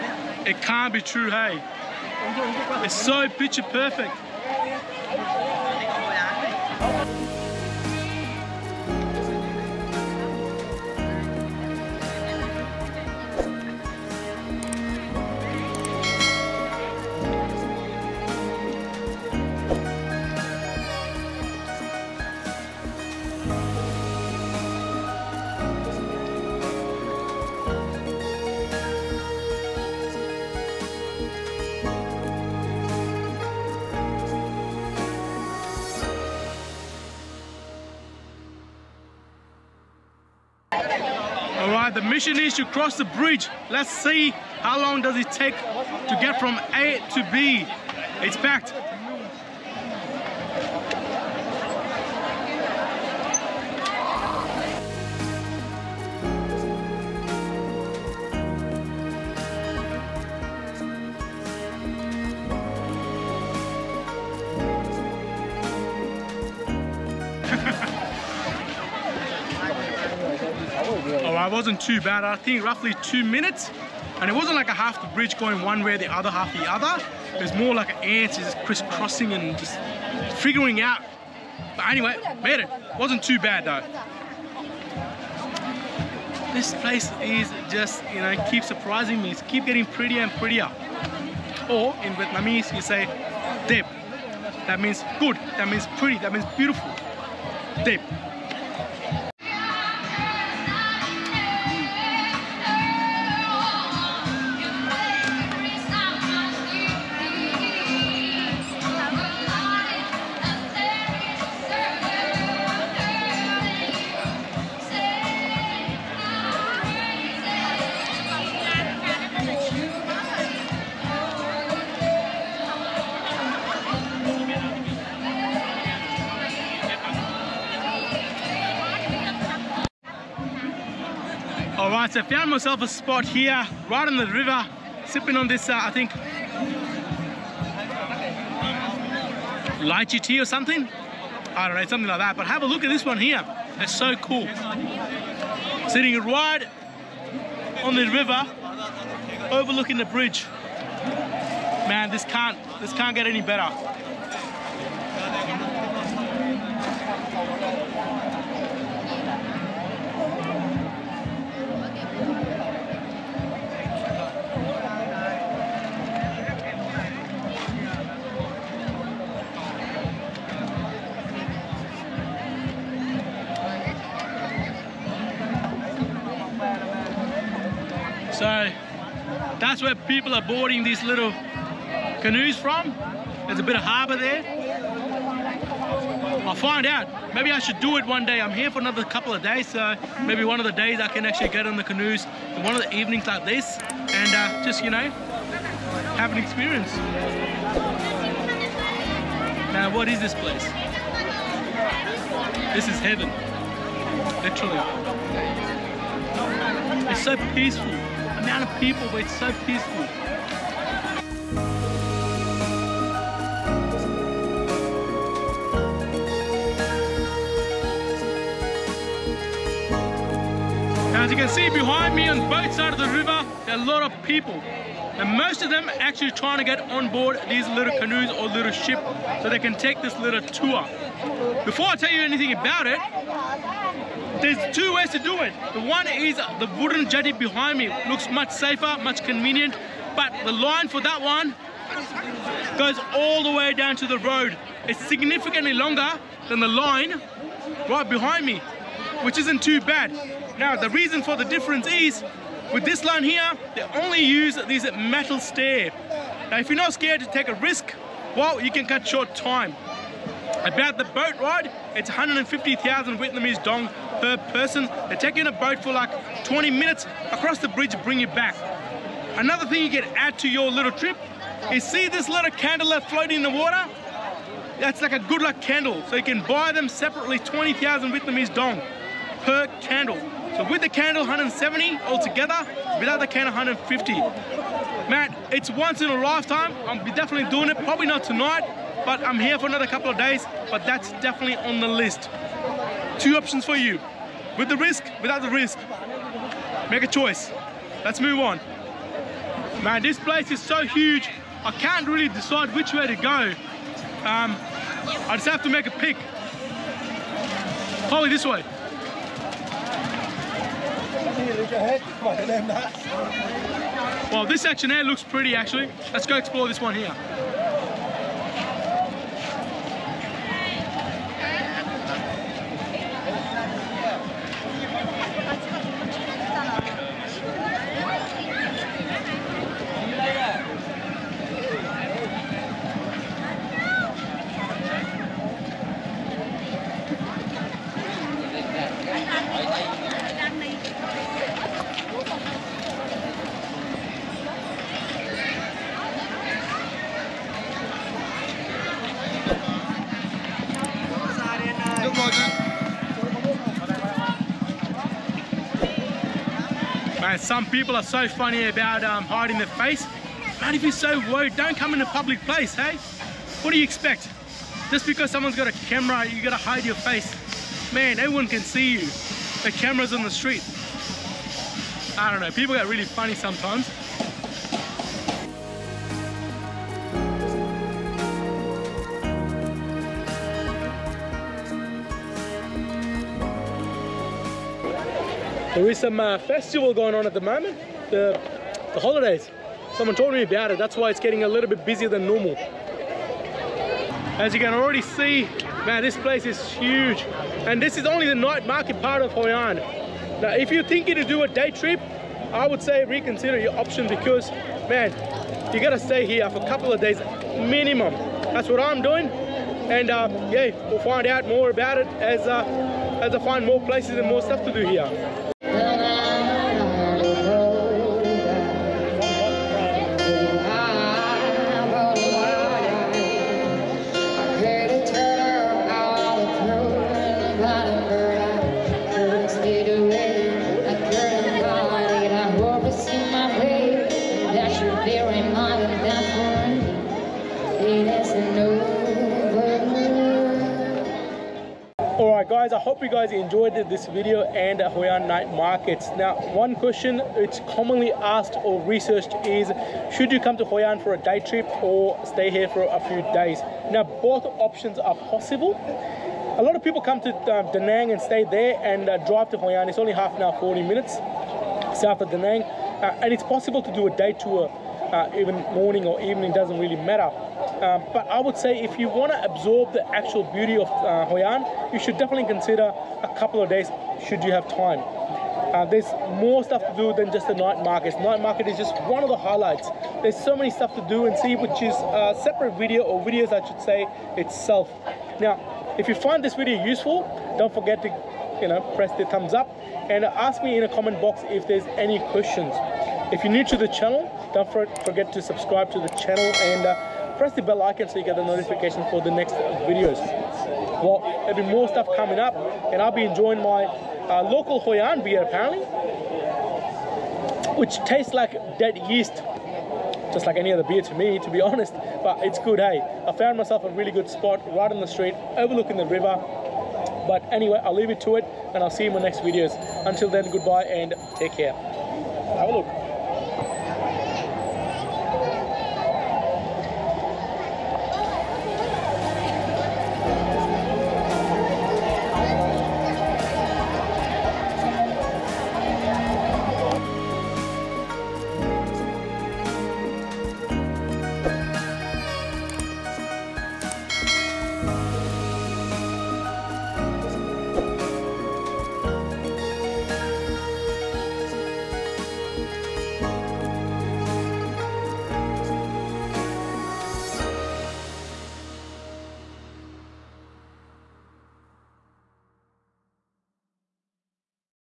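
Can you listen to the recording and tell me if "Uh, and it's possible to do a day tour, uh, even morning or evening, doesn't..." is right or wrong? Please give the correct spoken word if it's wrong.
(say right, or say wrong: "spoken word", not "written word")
right.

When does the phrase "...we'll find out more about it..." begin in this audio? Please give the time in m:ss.
6:50.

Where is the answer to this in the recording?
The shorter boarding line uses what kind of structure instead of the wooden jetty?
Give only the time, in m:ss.
4:14.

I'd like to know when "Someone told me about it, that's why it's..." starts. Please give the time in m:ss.
6:29.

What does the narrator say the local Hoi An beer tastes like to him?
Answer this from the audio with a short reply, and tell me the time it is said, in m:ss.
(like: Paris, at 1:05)
dead yeast, at 8:28.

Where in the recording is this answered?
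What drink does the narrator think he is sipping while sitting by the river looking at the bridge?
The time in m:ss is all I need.
2:19.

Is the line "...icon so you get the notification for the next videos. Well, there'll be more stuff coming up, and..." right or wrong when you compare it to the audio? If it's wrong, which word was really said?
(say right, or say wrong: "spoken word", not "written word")
right.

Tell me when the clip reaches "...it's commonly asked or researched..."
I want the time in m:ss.
7:27.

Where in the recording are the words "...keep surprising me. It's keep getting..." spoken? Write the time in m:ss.
1:28.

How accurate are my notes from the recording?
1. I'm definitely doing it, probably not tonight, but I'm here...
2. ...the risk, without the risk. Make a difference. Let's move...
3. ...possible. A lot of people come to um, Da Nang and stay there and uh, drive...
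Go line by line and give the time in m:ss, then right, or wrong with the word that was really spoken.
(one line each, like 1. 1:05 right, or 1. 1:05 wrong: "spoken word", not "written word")
1. 4:46 right
2. 4:54 wrong: "choice", not "difference"
3. 7:35 right.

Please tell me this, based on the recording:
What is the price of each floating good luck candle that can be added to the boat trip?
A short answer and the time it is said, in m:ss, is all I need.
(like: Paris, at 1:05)
20,000 dong, at 4:37.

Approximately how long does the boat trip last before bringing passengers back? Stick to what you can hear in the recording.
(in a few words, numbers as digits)
20 minutes.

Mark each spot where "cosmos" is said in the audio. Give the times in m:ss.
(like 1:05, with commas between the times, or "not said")
not said.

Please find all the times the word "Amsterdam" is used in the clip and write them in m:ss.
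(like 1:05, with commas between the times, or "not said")
not said.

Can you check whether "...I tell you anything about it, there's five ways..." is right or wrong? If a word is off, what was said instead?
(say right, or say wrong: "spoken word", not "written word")
wrong: "two", not "five".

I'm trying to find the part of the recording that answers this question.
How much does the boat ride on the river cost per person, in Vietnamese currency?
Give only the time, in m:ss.
4:22.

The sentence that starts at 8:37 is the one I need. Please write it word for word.
But anyway, I'll leave it to it, and I'll see you in my next videos.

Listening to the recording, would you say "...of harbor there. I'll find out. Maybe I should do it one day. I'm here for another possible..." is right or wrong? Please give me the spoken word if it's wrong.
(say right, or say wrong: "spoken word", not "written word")
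wrong: "couple", not "possible".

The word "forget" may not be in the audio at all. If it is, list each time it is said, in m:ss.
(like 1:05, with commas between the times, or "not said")
8:07, 8:14.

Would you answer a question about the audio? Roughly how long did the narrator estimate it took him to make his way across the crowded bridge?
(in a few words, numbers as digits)
2 minutes.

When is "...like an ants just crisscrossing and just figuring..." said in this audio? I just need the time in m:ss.
1:17.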